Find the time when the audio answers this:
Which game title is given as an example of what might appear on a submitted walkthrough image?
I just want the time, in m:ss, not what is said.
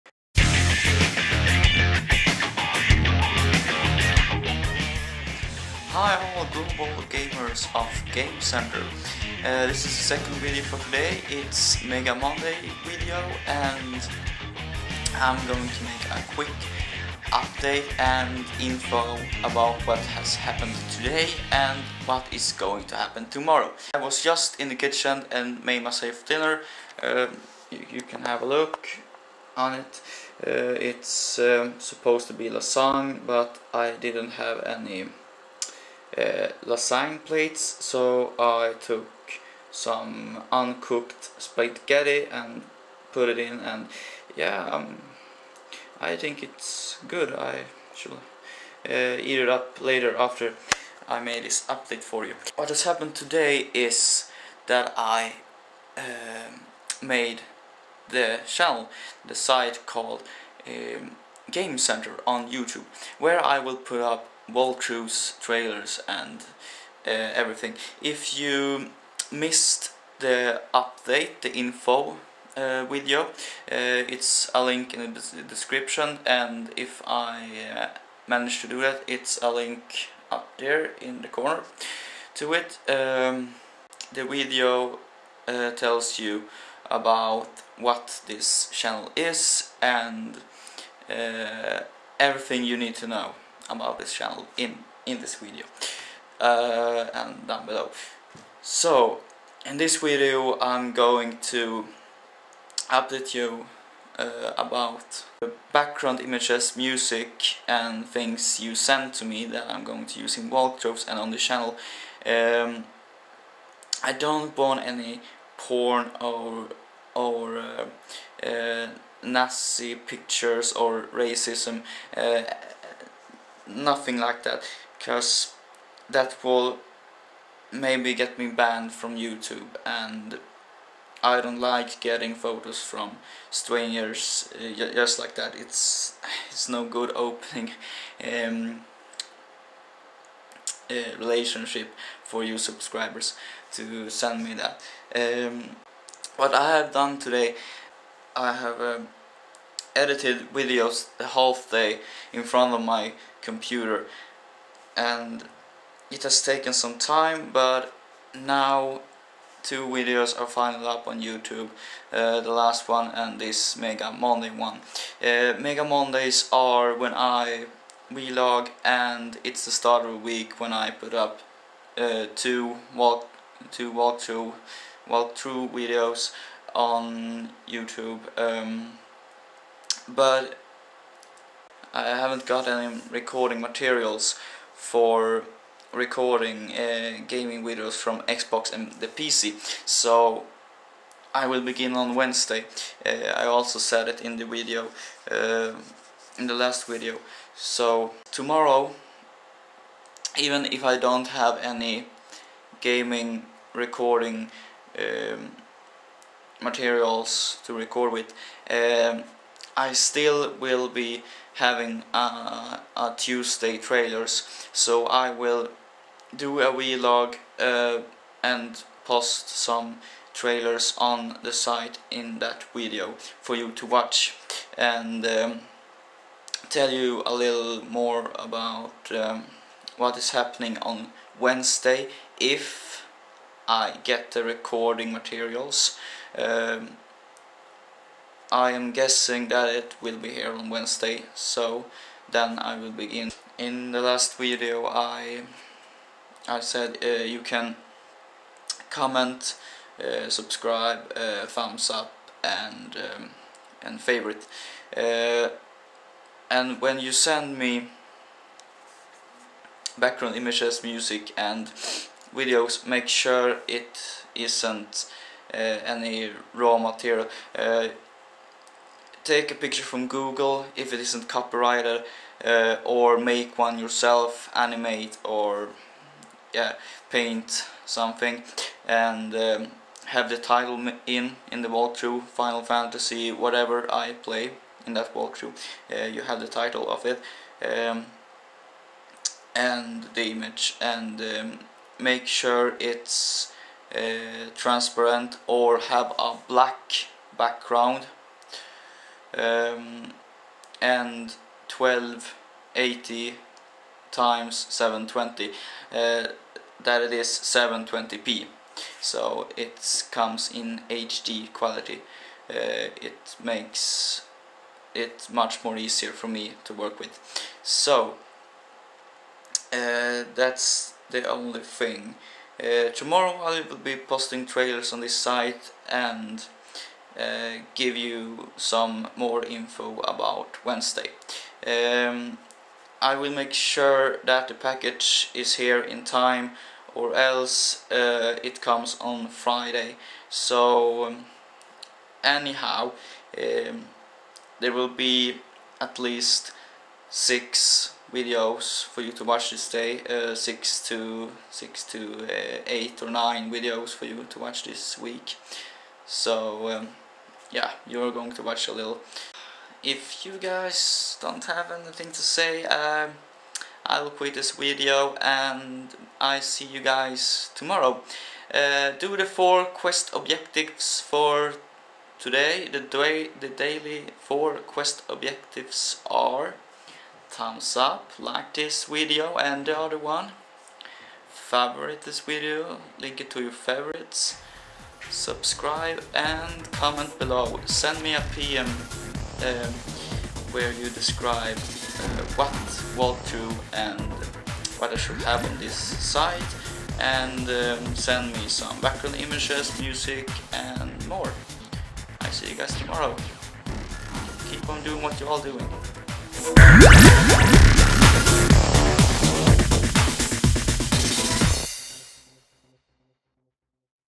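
4:42.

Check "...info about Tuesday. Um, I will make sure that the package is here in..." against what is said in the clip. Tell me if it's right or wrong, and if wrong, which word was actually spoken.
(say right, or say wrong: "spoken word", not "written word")
wrong: "Wednesday", not "Tuesday".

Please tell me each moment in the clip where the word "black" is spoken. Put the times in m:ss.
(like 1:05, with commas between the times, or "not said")
4:56.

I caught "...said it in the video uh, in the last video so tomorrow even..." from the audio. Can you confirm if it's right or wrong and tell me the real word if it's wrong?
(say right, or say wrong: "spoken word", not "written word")
right.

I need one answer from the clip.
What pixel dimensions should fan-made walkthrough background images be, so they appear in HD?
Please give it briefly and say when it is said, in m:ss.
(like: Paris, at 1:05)
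1280 x 720, at 5:01.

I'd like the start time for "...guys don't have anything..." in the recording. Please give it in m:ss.
6:00.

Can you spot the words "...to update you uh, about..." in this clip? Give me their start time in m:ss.
1:41.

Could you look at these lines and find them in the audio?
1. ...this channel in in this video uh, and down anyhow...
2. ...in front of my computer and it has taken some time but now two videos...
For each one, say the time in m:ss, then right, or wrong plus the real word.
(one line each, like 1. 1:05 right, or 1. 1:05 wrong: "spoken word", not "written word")
1. 1:33 wrong: "below", not "anyhow"
2. 2:32 right.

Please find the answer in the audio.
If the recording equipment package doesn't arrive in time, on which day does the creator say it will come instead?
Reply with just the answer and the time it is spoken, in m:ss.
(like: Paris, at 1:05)
Friday, at 5:39.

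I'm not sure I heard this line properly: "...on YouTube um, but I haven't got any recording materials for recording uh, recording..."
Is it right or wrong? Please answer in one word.
wrong.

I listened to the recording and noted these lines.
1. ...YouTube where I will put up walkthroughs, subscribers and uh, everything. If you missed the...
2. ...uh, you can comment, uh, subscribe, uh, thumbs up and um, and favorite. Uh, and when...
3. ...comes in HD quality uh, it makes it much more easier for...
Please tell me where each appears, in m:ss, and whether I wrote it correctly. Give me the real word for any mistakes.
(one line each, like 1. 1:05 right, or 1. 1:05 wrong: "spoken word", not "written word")
1. 1:02 wrong: "trailers", not "subscribers"
2. 4:07 right
3. 5:10 right.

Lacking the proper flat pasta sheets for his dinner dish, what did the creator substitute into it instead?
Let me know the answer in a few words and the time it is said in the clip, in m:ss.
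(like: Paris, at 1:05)
uncooked spaghetti, at 0:40.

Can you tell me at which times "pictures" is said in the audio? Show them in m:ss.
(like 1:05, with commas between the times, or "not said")
1:59, 4:29.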